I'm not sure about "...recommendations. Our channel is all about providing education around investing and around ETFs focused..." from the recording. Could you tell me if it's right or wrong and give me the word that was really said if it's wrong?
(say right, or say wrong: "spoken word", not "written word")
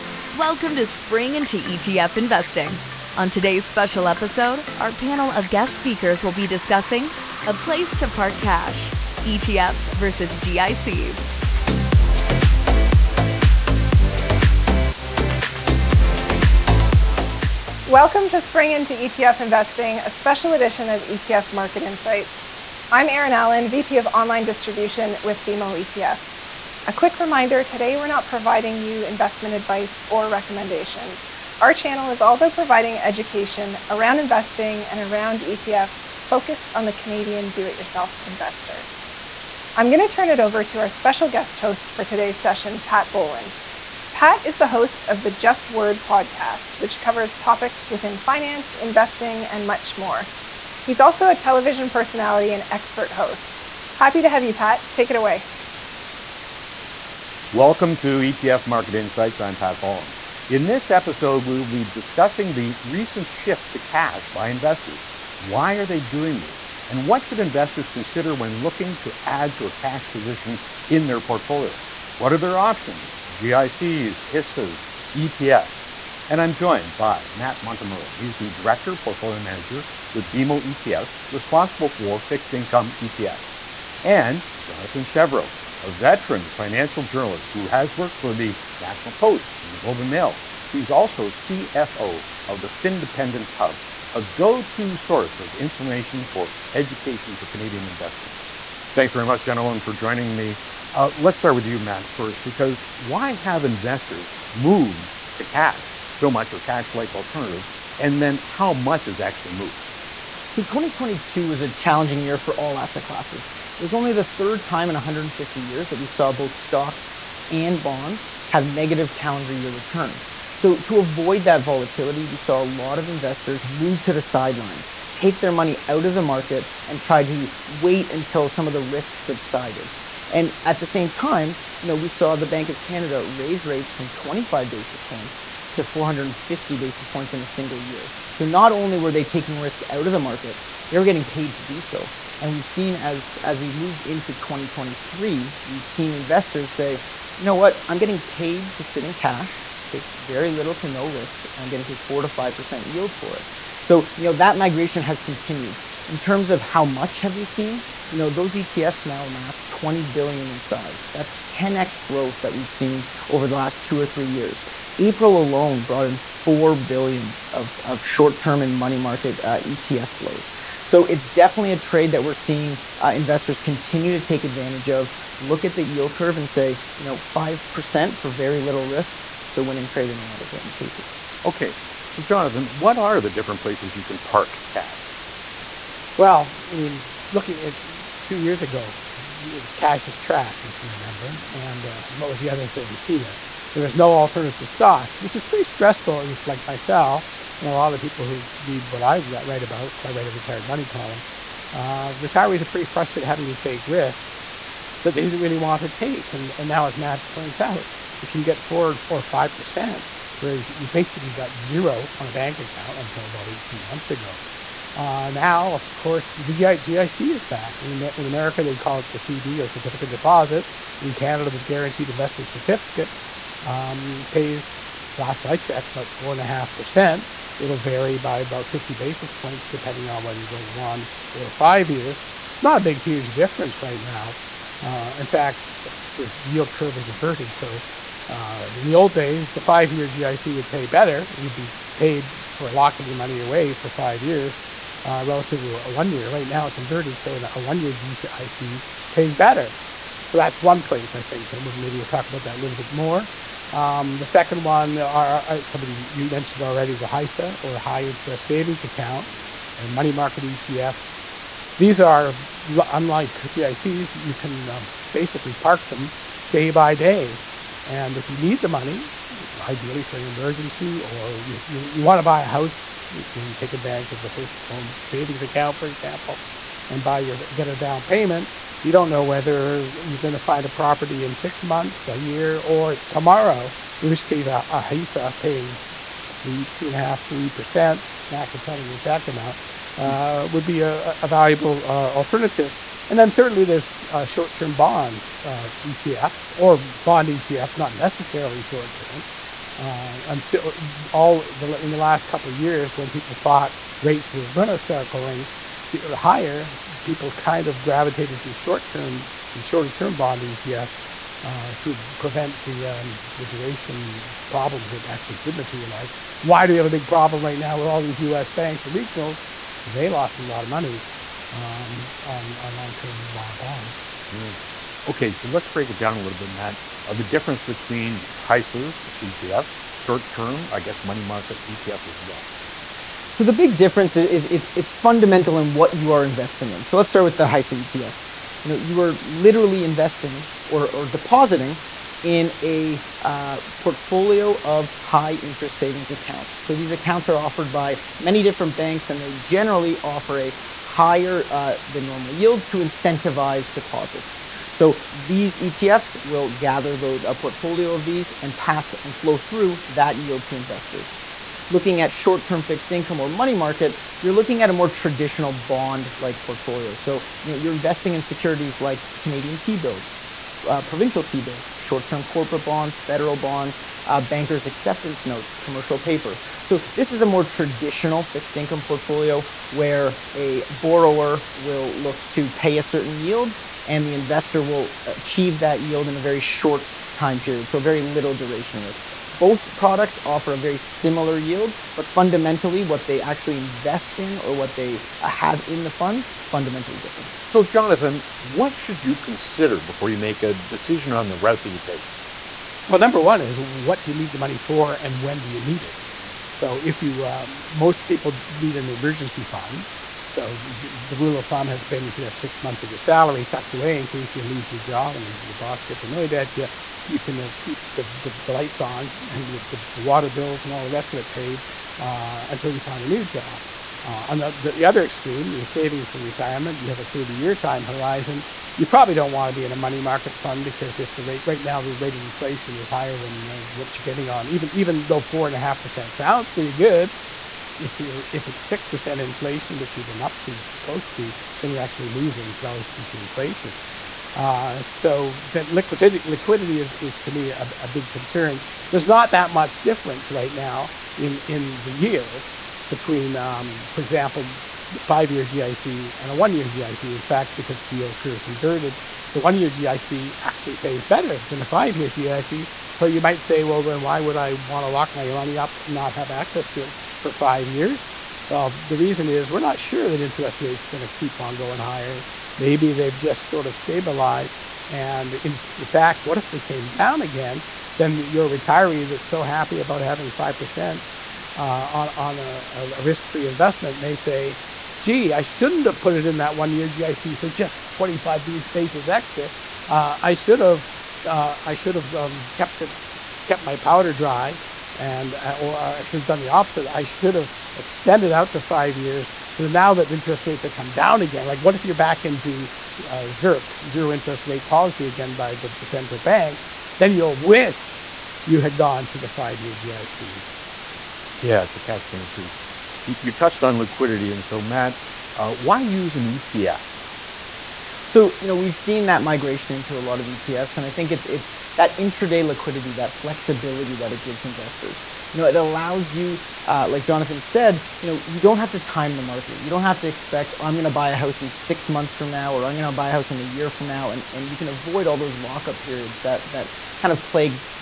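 right.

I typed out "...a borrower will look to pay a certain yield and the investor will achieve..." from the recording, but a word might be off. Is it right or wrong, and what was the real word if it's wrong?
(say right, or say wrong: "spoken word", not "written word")
right.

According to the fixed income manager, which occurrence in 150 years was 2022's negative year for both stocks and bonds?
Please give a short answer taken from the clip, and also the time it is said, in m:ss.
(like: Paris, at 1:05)
third, at 1:54.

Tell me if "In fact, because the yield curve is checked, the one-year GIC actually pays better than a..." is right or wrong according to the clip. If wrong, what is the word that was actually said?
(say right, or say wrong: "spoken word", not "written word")
wrong: "inverted", not "checked".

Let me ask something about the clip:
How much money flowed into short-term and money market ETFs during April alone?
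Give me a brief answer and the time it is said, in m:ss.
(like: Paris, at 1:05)
4 billion, at 2:46.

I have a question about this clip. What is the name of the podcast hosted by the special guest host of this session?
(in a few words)
Just Word.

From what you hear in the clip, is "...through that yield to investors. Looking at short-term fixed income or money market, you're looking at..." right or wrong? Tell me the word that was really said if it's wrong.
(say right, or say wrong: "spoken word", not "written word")
right.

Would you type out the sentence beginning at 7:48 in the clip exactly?
Well, the reason is we're not sure that interest rates are going to keep on going higher.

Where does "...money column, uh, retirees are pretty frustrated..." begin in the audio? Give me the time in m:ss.
3:20.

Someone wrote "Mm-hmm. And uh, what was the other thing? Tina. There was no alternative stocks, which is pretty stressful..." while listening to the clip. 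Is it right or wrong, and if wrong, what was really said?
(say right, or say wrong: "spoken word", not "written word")
right.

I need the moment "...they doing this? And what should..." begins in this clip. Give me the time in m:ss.
1:05.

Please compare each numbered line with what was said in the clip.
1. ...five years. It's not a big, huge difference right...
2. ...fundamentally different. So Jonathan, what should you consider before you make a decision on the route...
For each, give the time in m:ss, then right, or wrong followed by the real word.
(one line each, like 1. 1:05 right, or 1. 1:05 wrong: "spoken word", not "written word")
1. 3:51 right
2. 6:36 right.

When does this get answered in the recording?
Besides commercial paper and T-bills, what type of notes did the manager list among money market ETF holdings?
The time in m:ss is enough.
6:14.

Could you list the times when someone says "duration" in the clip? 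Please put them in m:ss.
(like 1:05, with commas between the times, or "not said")
5:13, 6:28.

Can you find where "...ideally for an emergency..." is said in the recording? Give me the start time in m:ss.
4:29.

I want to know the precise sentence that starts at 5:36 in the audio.
So let's start with the HISA ETFs.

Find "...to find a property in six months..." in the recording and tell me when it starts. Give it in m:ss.
4:40.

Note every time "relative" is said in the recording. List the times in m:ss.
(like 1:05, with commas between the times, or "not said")
4:05, 7:22.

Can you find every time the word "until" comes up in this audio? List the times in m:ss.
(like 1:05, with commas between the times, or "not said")
2:08, 3:32, 5:00, 7:02.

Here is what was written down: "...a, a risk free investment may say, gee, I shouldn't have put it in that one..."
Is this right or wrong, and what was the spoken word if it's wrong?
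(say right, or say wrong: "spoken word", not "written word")
right.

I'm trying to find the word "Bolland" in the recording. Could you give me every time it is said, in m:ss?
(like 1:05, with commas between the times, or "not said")
0:43, 0:59.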